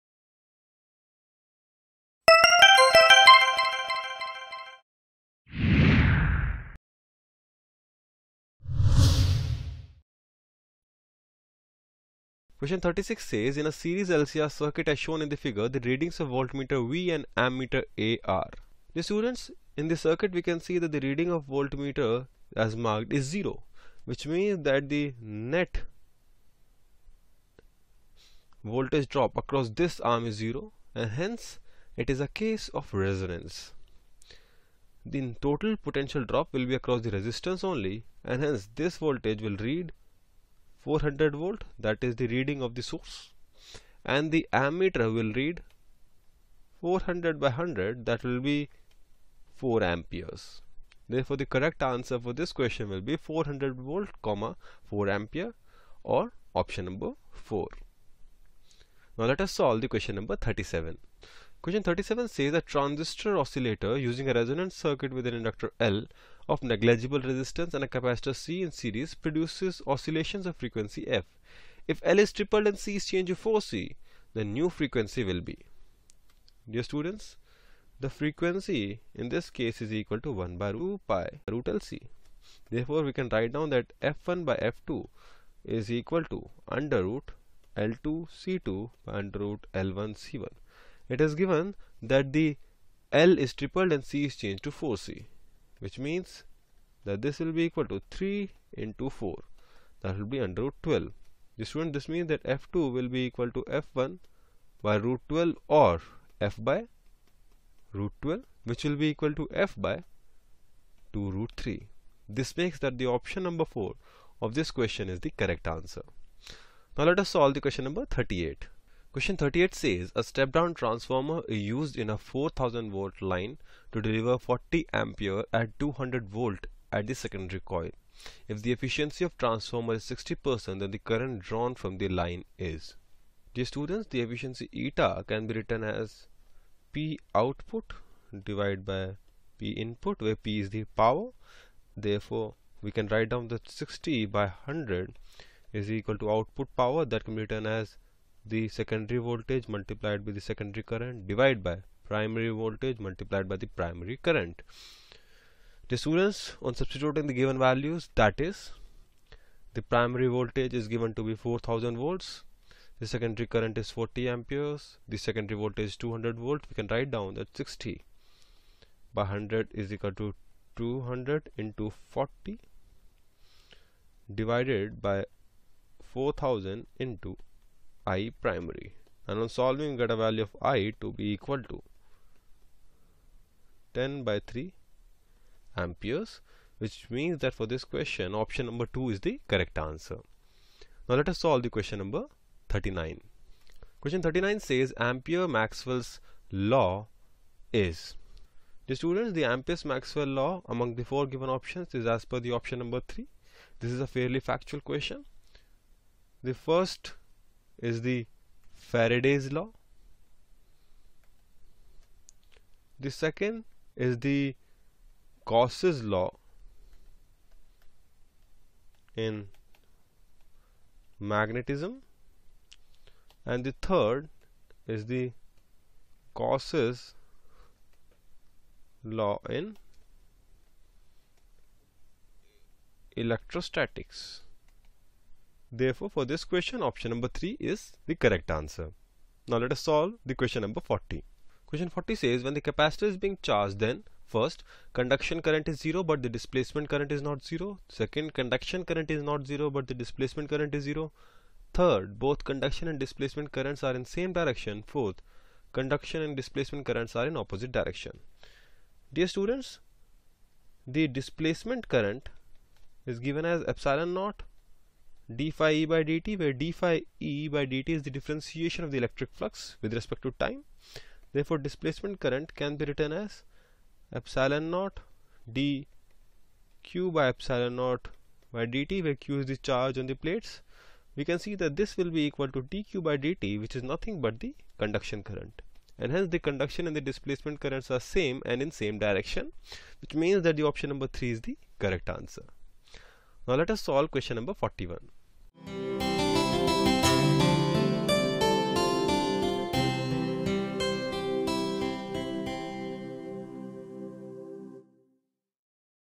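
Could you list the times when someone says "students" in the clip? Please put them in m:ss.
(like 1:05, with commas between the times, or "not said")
0:19, 1:16, 1:41, 2:13, 2:35, 3:19, 4:19.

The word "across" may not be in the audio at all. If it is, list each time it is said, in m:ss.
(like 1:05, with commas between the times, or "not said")
0:29, 0:36.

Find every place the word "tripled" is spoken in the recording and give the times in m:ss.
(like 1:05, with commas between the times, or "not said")
1:12, 1:33.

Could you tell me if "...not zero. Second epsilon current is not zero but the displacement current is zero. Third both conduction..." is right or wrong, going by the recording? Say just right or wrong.
wrong.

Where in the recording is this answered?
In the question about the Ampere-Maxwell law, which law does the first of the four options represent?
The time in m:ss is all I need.
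3:28.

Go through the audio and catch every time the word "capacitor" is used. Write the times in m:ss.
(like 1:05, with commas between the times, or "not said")
1:07, 4:02.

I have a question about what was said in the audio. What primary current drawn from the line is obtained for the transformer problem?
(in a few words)
10/3 amperes.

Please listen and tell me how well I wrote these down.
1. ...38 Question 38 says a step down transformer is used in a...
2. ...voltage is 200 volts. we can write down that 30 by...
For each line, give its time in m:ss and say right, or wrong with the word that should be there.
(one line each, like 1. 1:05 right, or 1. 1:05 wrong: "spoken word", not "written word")
1. 1:58 right
2. 2:45 wrong: "60", not "30".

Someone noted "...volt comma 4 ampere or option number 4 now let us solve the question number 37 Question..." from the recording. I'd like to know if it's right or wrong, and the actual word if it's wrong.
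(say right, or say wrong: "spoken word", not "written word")
right.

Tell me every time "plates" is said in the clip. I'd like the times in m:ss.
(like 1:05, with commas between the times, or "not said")
4:40.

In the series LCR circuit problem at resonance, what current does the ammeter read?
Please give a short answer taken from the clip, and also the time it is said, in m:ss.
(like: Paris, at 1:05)
4 amperes, at 0:49.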